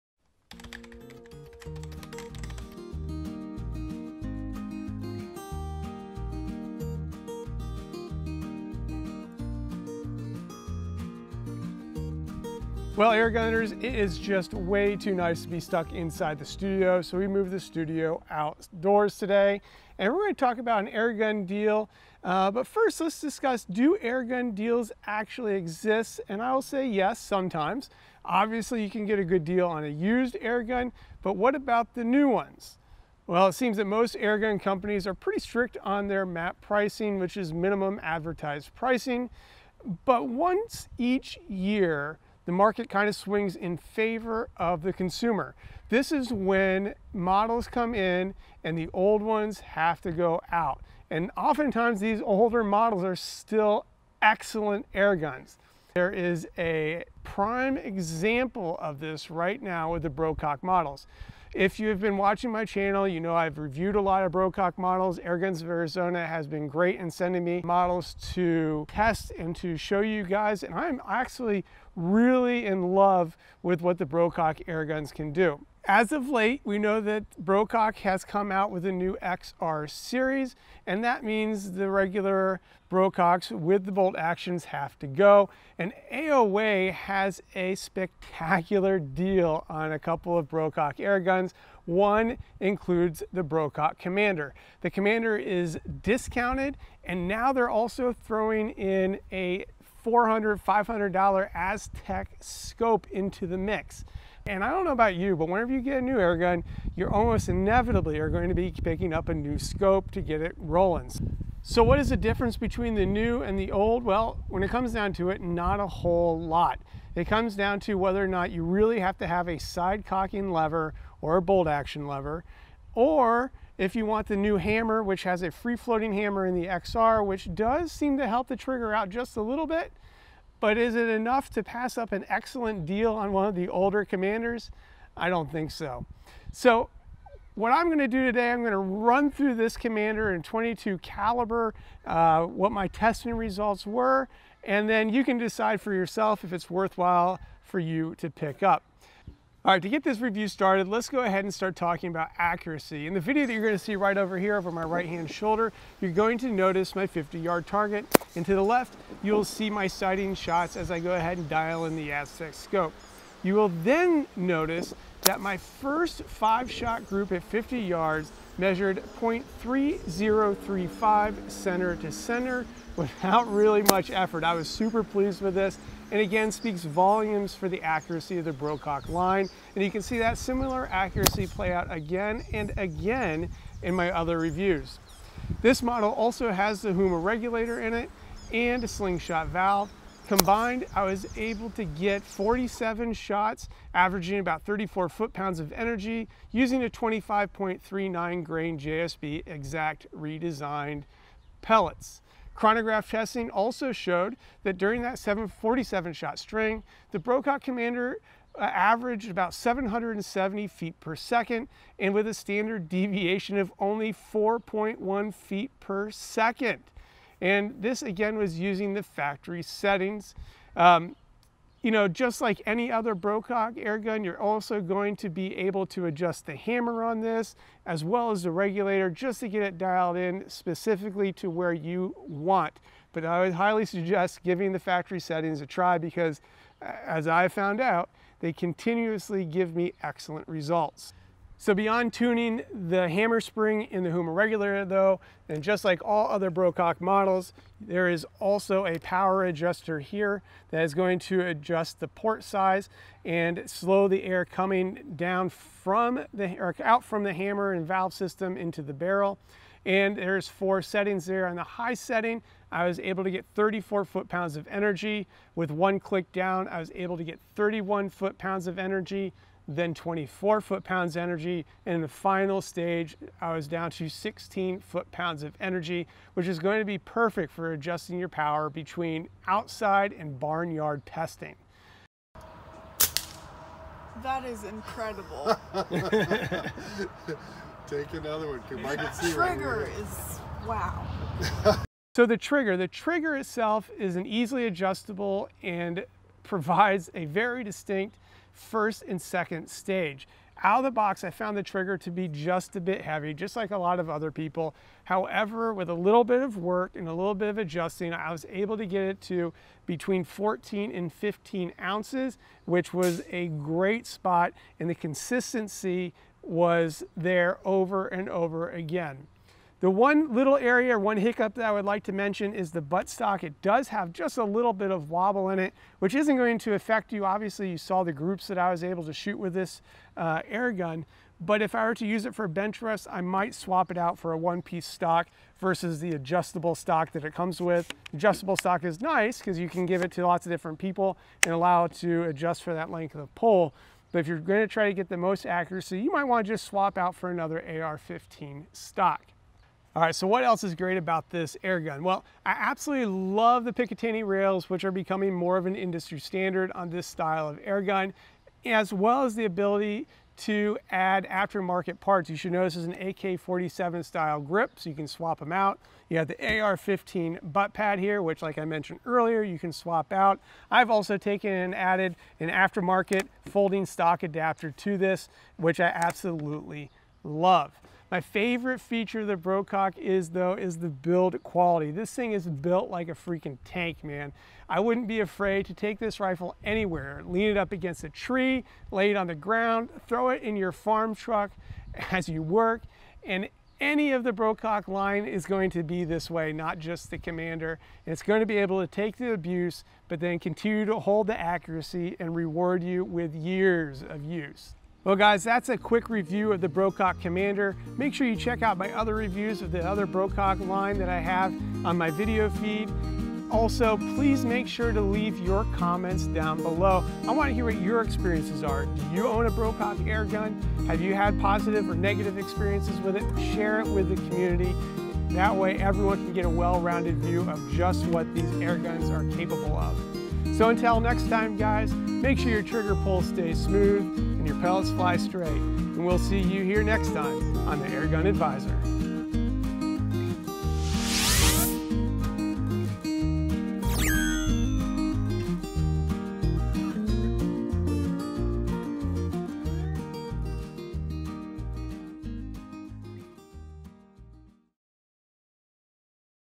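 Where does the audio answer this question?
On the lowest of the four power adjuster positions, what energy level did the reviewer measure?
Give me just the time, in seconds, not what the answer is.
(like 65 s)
274 s.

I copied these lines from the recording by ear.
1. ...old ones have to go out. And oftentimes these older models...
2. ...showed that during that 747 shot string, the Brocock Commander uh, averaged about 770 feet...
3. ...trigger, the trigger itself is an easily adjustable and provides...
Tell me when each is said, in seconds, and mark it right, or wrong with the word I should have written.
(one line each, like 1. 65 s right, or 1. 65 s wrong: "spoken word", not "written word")
1. 48 s right
2. 203 s right
3. 292 s right.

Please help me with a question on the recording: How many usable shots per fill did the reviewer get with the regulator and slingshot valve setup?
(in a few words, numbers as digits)
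47.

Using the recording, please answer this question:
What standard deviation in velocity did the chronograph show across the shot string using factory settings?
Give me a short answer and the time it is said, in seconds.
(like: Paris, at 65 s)
4.1 feet per second, at 214 s.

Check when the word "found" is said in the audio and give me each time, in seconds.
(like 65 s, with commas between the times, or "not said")
237 s, 301 s.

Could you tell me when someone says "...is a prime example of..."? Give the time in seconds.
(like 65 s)
56 s.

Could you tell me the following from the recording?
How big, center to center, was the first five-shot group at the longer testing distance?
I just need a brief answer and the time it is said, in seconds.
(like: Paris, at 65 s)
0.3035, at 169 s.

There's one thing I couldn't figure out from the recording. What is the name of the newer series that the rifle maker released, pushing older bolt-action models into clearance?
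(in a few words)
XR series.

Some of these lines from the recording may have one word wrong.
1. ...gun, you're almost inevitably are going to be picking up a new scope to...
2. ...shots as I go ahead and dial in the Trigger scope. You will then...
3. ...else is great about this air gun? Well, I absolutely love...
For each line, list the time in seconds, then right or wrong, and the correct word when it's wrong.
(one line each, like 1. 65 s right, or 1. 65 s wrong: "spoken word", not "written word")
1. 106 s right
2. 160 s wrong: "Aztec", not "Trigger"
3. 350 s right.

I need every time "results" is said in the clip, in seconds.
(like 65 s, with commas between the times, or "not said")
143 s, 240 s.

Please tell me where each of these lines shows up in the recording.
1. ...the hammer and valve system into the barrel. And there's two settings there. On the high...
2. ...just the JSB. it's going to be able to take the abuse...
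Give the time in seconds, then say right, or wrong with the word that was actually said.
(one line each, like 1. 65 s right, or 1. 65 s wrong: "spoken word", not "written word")
1. 257 s wrong: "four", not "two"
2. 396 s wrong: "Commander", not "JSB".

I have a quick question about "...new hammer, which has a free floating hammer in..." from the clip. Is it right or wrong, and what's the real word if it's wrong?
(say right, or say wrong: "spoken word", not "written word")
right.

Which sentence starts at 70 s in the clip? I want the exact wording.
And I'm actually really in love with what the Brocock airguns can do.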